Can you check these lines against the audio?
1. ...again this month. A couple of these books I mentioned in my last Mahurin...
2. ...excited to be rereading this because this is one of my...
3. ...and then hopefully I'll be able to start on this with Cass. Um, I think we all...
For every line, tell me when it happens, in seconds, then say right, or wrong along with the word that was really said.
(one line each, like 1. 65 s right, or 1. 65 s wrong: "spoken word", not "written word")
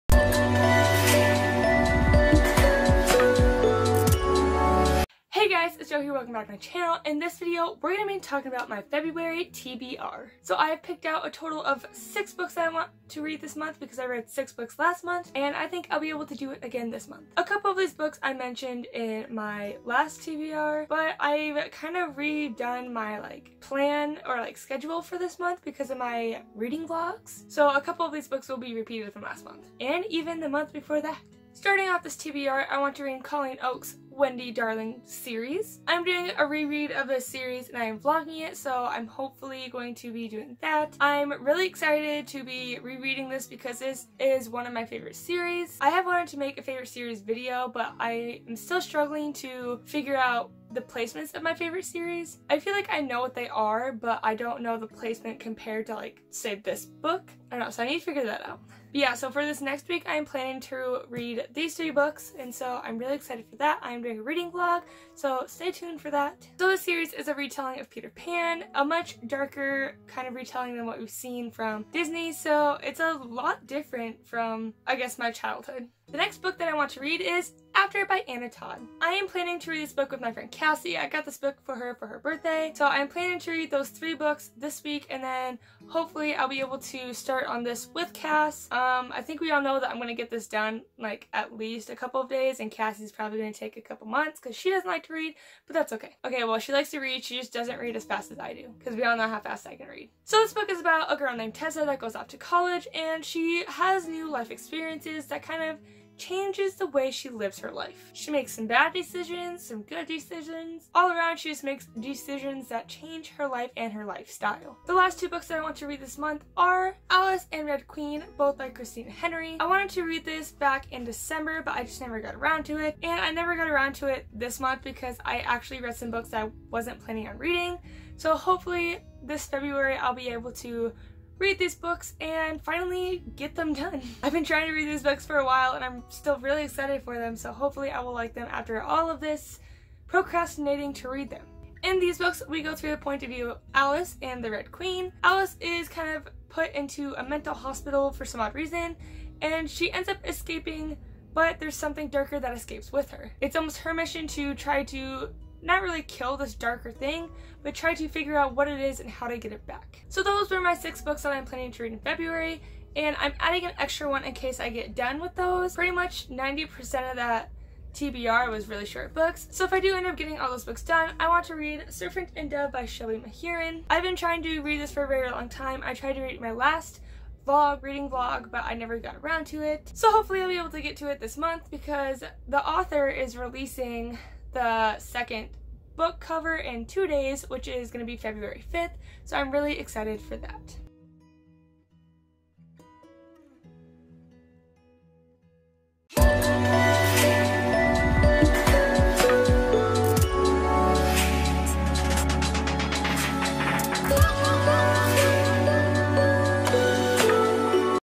1. 16 s wrong: "TBR", not "Mahurin"
2. 41 s right
3. 85 s right.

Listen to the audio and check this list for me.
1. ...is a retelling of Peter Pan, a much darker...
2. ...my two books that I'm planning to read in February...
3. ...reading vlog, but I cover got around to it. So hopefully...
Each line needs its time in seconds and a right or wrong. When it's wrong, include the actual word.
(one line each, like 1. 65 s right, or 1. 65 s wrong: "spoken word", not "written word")
1. 67 s right
2. 160 s wrong: "six", not "two"
3. 177 s wrong: "never", not "cover".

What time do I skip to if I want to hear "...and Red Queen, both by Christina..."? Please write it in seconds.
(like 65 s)
117 s.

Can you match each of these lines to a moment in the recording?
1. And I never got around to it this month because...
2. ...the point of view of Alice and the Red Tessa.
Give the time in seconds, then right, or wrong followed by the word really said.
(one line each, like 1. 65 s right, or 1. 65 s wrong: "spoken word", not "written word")
1. 123 s right
2. 142 s wrong: "Queen", not "Tessa".